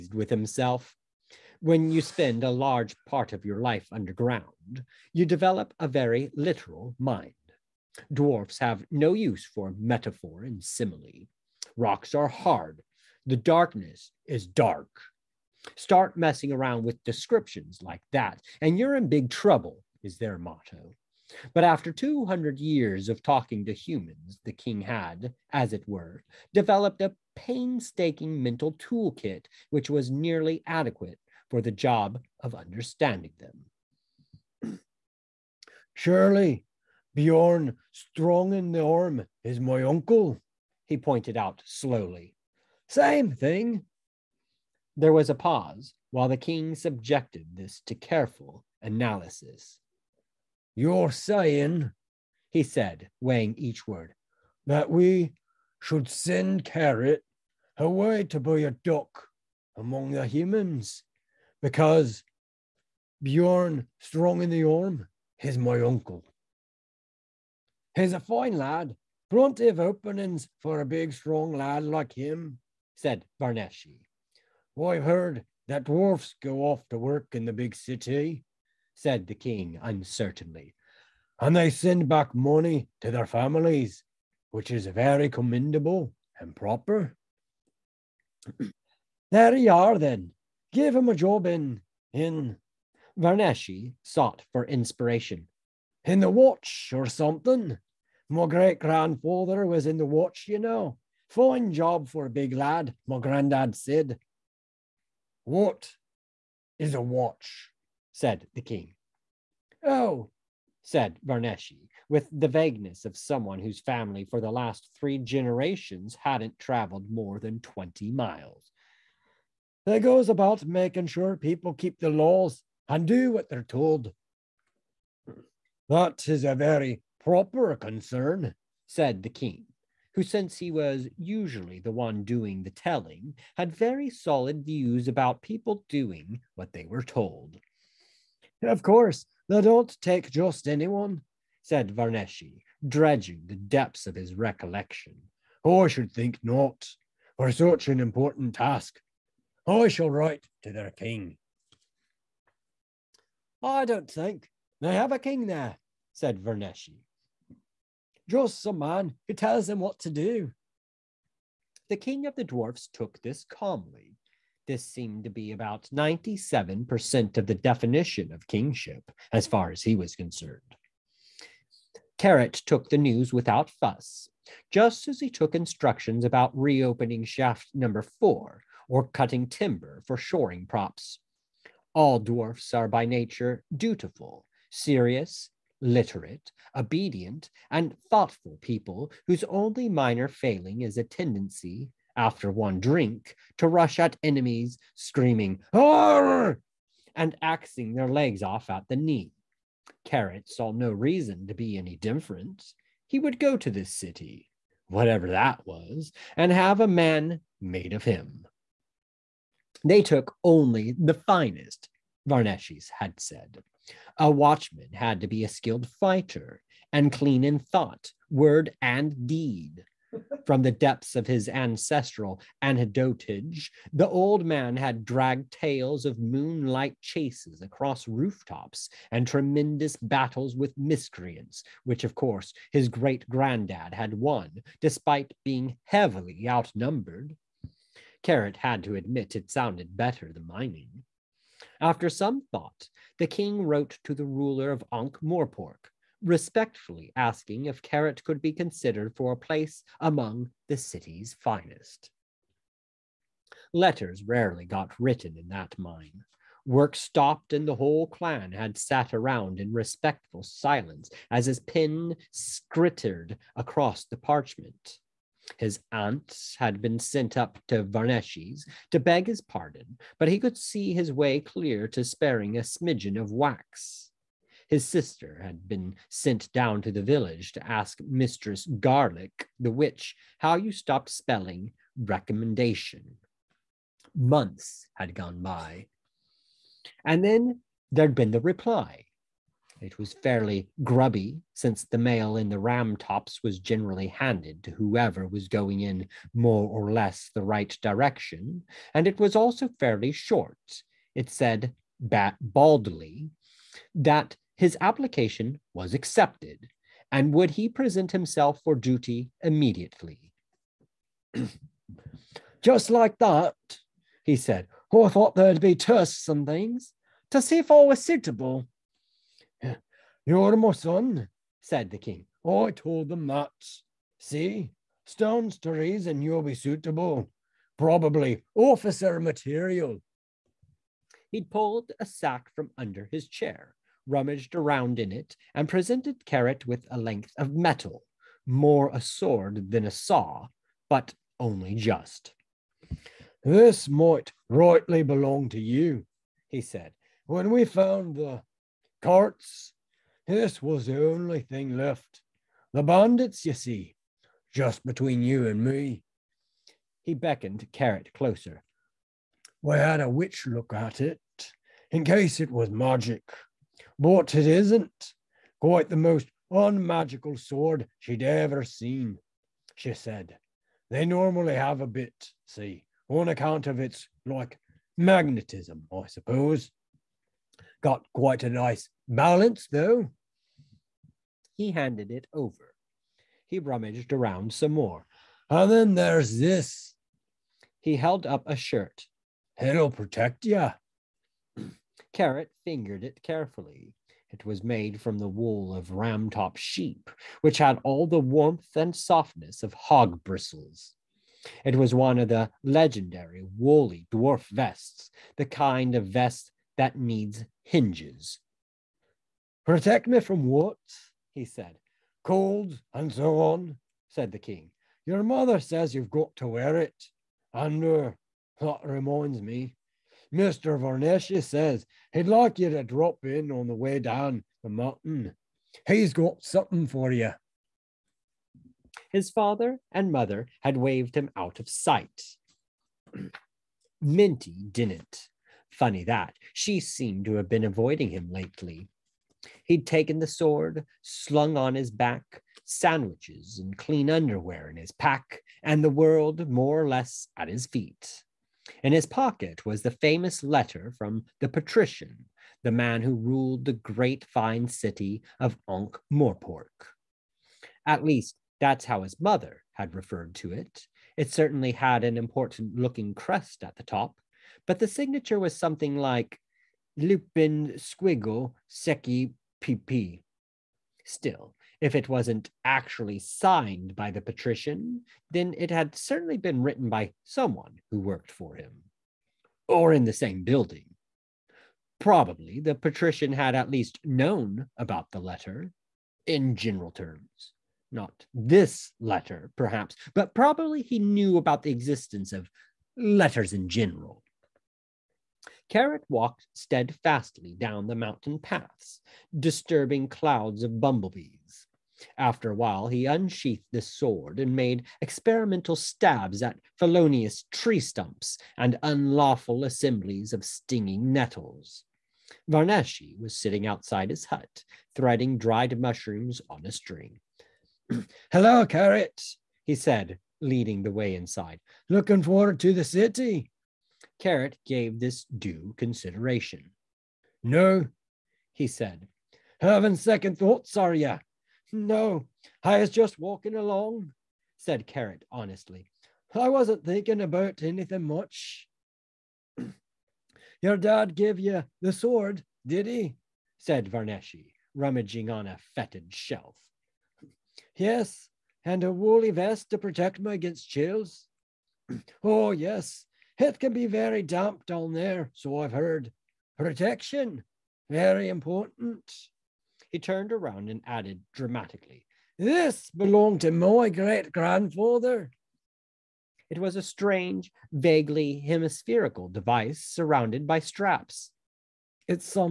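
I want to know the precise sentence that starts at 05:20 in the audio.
You're my son, said the king.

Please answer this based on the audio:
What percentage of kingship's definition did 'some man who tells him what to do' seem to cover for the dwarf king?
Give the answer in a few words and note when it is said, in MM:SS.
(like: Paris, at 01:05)
97%, at 02:45.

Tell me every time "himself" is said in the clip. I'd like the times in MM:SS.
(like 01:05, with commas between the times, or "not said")
00:00, 05:08.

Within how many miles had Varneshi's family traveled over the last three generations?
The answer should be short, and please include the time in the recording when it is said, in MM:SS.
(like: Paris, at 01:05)
20, at 01:57.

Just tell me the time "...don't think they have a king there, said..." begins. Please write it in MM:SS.
02:33.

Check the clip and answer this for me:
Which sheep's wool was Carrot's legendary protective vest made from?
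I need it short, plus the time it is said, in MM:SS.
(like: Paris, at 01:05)
Ramtop sheep, at 06:35.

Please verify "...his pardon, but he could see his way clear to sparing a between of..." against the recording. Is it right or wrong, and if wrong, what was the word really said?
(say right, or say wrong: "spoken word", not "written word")
wrong: "smidgen", not "between".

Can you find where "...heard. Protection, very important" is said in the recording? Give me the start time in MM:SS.
09:15.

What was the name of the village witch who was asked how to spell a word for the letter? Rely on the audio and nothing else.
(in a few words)
Mistress Garlic.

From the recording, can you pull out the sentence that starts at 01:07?
He's a fine lad, plenty of openings for a big, strong lad like him, said Varneshi.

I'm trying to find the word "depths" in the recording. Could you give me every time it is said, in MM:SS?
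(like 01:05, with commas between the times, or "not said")
02:23, 03:40.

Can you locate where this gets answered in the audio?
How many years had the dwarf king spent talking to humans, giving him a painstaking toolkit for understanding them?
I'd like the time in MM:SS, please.
00:21.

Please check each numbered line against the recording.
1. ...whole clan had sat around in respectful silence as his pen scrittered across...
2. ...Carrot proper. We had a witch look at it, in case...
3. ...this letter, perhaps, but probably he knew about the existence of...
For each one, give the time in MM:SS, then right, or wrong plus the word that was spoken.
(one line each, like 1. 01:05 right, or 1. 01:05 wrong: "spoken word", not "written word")
1. 04:17 right
2. 05:57 wrong: "closer", not "proper"
3. 08:08 right.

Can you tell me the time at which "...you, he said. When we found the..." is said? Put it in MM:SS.
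05:45.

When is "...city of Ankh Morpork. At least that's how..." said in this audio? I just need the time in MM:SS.
07:34.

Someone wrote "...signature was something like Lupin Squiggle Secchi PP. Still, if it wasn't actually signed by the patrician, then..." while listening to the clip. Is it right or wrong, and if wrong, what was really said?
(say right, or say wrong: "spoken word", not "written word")
right.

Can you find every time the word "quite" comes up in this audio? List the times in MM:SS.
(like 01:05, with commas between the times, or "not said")
06:05, 06:18.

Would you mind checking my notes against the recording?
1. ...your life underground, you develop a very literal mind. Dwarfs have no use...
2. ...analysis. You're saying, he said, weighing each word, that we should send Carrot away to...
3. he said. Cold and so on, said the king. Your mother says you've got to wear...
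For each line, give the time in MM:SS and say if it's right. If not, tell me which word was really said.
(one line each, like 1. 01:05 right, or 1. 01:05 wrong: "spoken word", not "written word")
1. 00:03 right
2. 00:48 right
3. 06:51 right.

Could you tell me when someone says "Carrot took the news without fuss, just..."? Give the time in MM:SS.
02:52.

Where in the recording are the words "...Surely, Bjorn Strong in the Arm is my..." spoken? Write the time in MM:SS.
00:35.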